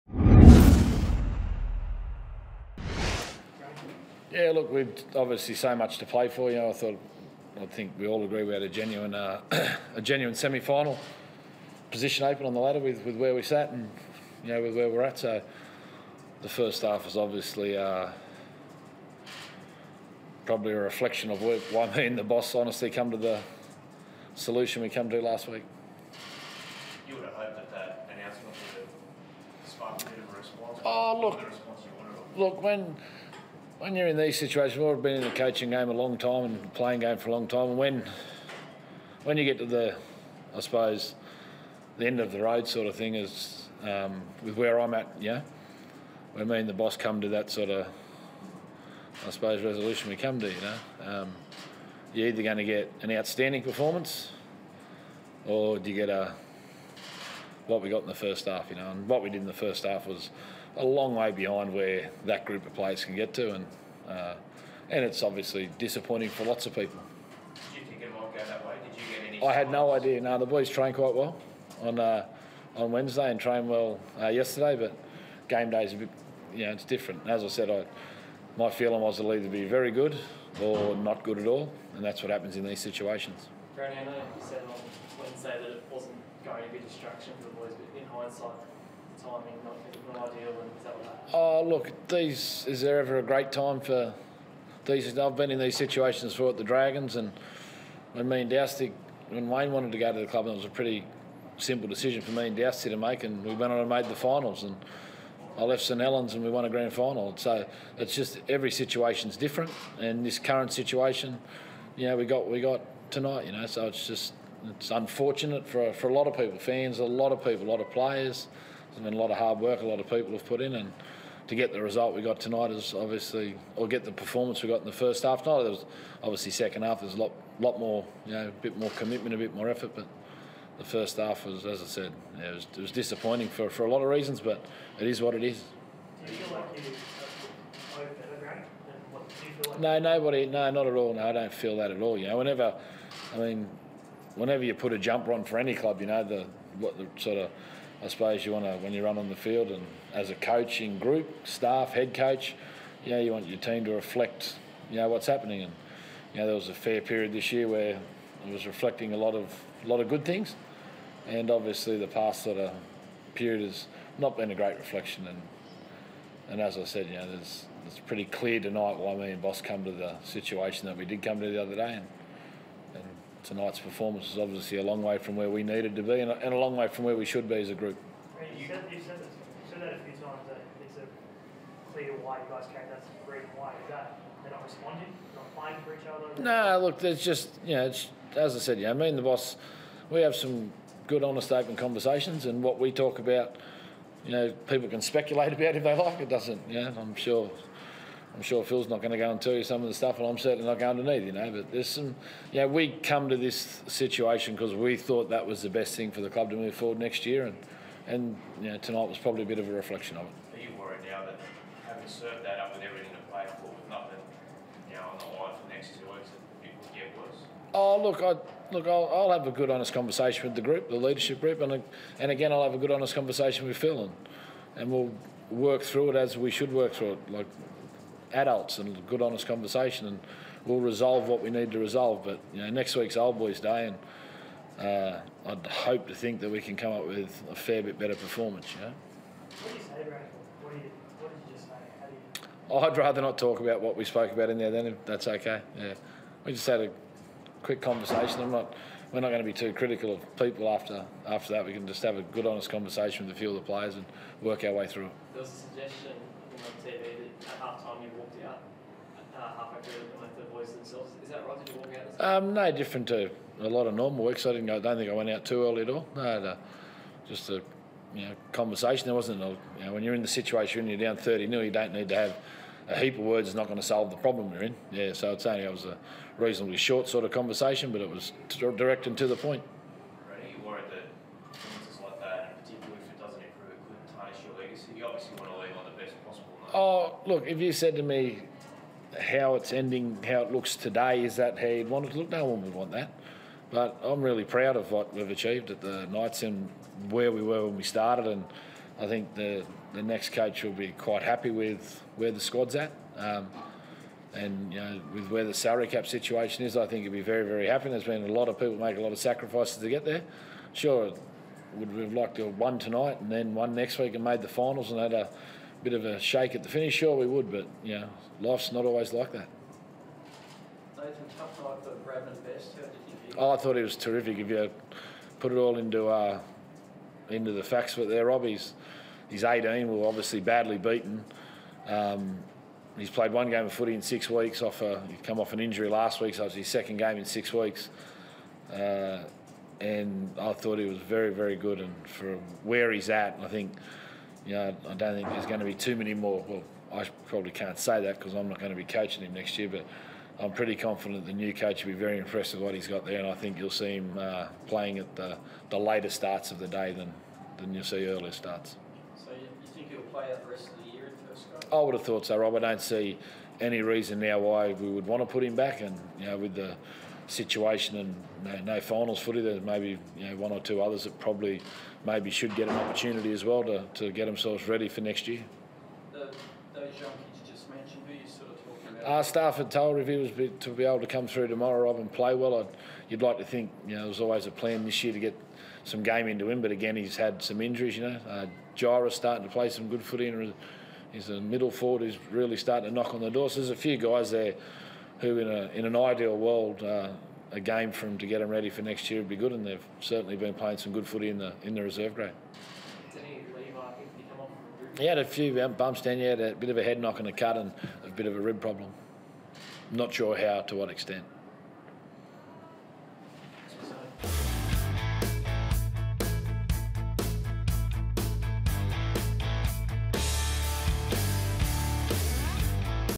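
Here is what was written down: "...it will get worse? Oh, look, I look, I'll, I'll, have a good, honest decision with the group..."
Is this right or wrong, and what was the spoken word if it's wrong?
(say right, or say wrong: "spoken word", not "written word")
wrong: "conversation", not "decision".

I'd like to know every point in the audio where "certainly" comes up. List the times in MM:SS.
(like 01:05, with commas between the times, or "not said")
03:20, 06:39.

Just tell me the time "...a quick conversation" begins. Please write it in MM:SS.
04:06.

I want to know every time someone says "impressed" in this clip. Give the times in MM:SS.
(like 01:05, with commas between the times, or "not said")
05:52.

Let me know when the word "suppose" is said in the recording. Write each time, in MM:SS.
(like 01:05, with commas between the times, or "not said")
00:40, 00:49, 02:28.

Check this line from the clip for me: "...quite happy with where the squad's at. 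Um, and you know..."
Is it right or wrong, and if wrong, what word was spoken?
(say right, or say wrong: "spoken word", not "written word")
right.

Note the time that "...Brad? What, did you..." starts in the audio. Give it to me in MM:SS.
04:00.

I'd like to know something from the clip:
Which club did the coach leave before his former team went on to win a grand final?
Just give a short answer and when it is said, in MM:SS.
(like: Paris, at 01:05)
St Helens, at 01:45.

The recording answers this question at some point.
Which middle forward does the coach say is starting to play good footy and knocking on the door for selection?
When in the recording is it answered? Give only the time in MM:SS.
06:28.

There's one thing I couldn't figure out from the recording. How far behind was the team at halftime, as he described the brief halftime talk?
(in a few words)
30-0.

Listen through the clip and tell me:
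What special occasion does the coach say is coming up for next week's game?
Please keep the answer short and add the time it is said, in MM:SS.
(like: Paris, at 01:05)
Old Boys Day, at 03:53.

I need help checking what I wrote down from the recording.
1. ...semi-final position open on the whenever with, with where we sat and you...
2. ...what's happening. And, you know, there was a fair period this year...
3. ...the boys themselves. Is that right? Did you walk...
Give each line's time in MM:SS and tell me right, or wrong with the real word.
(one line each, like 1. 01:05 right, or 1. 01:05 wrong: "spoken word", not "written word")
1. 00:10 wrong: "ladder", not "whenever"
2. 02:35 right
3. 04:20 right.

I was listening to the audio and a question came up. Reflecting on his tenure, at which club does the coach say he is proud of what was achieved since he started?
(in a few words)
Knights.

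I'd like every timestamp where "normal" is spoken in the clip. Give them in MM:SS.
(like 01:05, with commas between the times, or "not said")
04:23.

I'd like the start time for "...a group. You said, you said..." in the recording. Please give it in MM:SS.
02:57.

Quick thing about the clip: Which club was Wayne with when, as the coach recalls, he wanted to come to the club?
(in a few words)
Dragons.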